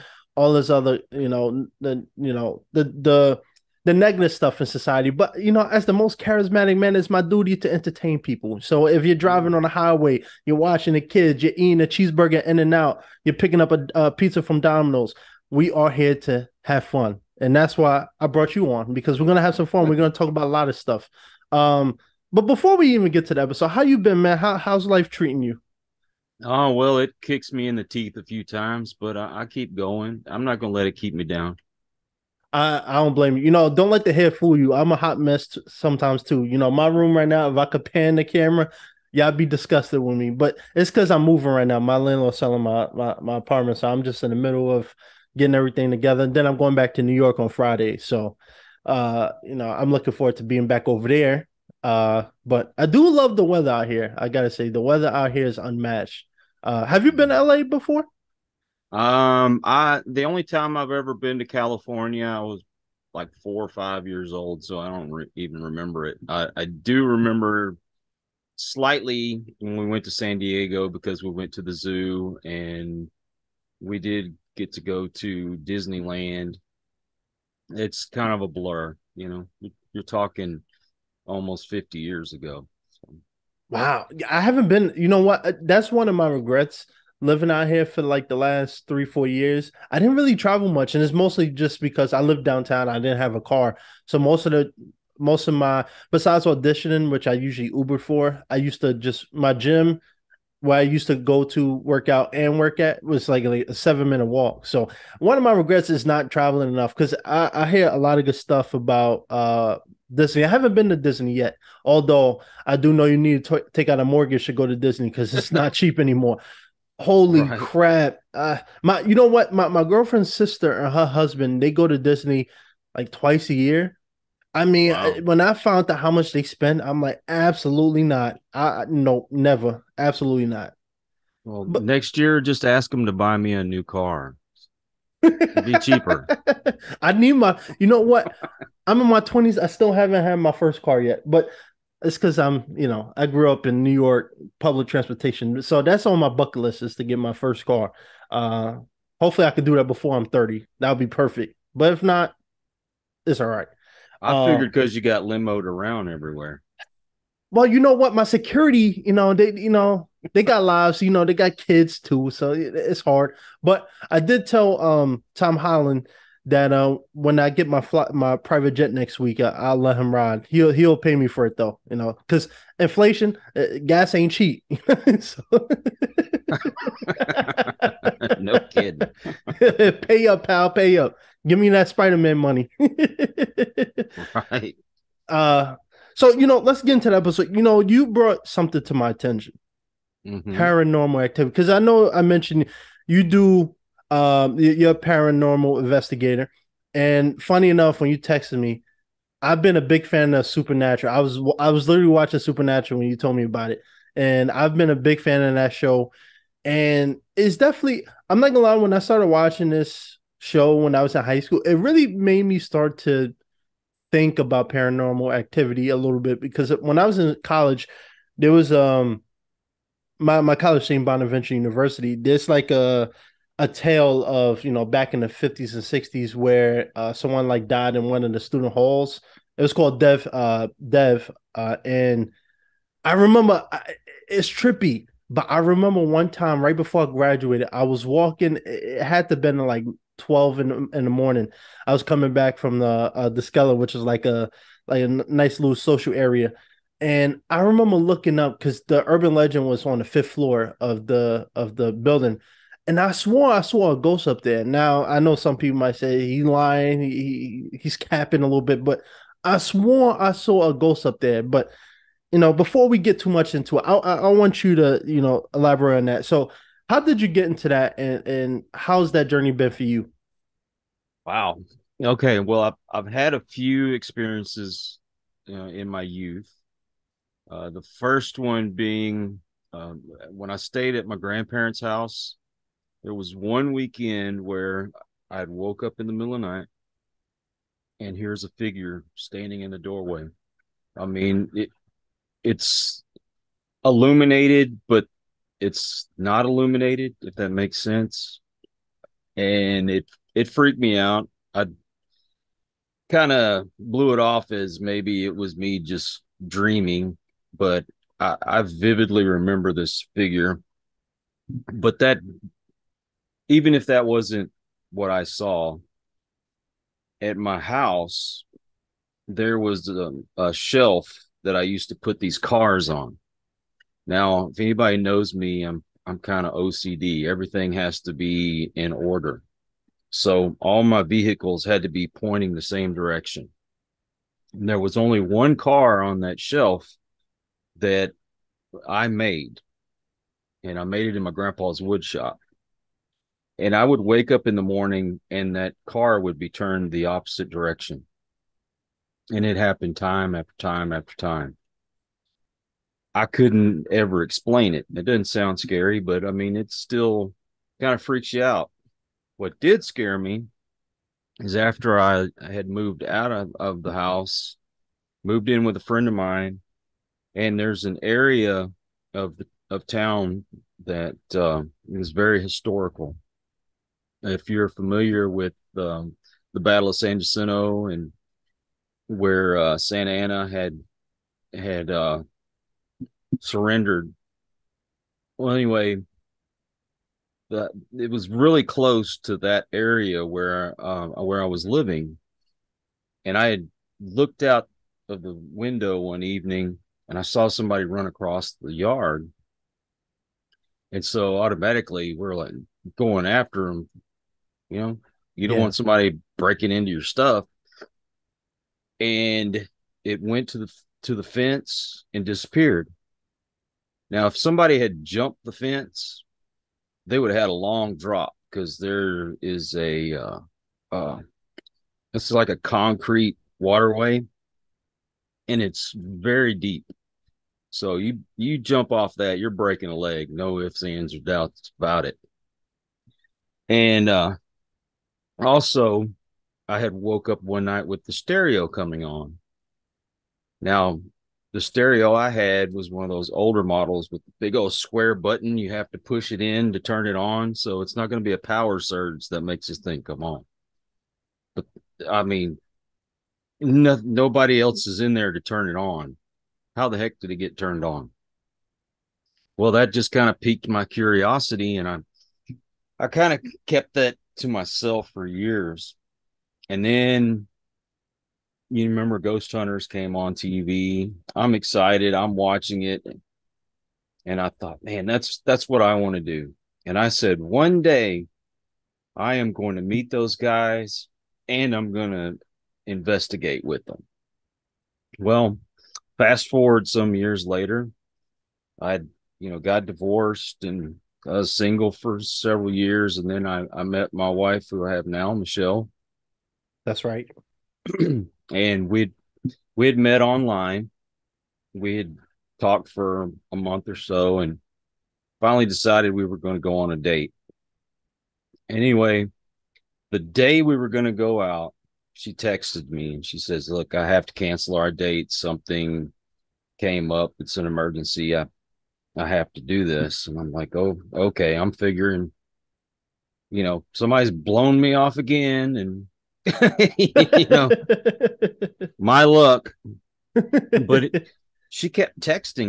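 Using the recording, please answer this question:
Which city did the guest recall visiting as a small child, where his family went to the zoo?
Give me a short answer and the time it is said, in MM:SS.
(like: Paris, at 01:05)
San Diego, at 01:10.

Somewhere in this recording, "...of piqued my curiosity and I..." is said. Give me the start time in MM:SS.
07:40.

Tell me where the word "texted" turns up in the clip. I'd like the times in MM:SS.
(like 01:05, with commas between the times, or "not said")
03:18, 08:32.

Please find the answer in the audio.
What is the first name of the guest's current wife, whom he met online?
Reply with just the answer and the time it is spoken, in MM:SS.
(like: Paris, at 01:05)
Michelle, at 08:15.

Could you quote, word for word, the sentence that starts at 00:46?
And then I'm going back to New York on Friday.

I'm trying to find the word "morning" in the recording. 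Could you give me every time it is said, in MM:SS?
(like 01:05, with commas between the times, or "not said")
04:01, 05:44.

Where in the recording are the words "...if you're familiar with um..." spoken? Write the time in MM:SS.
06:14.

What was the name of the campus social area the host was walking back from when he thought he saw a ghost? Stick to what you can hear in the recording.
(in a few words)
the Skeller.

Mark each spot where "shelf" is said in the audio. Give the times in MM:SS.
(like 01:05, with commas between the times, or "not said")
05:20, 05:36.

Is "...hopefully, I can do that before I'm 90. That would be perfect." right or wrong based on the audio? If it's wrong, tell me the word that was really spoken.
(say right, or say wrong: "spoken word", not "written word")
wrong: "30", not "90".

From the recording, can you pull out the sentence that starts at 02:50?
He'll he'll pay me for it though, you know, because inflation, uh, gas ain't cheap.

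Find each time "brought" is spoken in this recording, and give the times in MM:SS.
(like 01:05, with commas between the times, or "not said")
00:18, 03:08.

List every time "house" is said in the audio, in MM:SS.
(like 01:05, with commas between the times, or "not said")
04:41, 05:17, 06:03.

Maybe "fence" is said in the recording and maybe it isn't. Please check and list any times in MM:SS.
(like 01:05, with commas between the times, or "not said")
06:51, 06:55.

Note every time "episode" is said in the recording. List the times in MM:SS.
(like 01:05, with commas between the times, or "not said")
00:23, 03:07.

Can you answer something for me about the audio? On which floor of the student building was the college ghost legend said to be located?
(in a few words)
fifth floor.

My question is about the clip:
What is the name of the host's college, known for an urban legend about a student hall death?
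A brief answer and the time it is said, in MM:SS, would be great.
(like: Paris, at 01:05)
Bonaventure University, at 03:41.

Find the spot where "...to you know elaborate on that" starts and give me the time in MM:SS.
04:24.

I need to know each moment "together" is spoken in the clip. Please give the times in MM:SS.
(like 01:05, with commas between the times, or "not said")
00:45.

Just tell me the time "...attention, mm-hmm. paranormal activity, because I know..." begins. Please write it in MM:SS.
03:09.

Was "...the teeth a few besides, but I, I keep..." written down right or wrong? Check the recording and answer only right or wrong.
wrong.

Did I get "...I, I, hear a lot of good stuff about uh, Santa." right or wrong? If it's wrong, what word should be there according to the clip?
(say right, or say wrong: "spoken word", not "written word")
wrong: "Disney", not "Santa".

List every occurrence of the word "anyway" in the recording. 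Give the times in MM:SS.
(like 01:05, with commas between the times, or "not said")
06:25, 08:28.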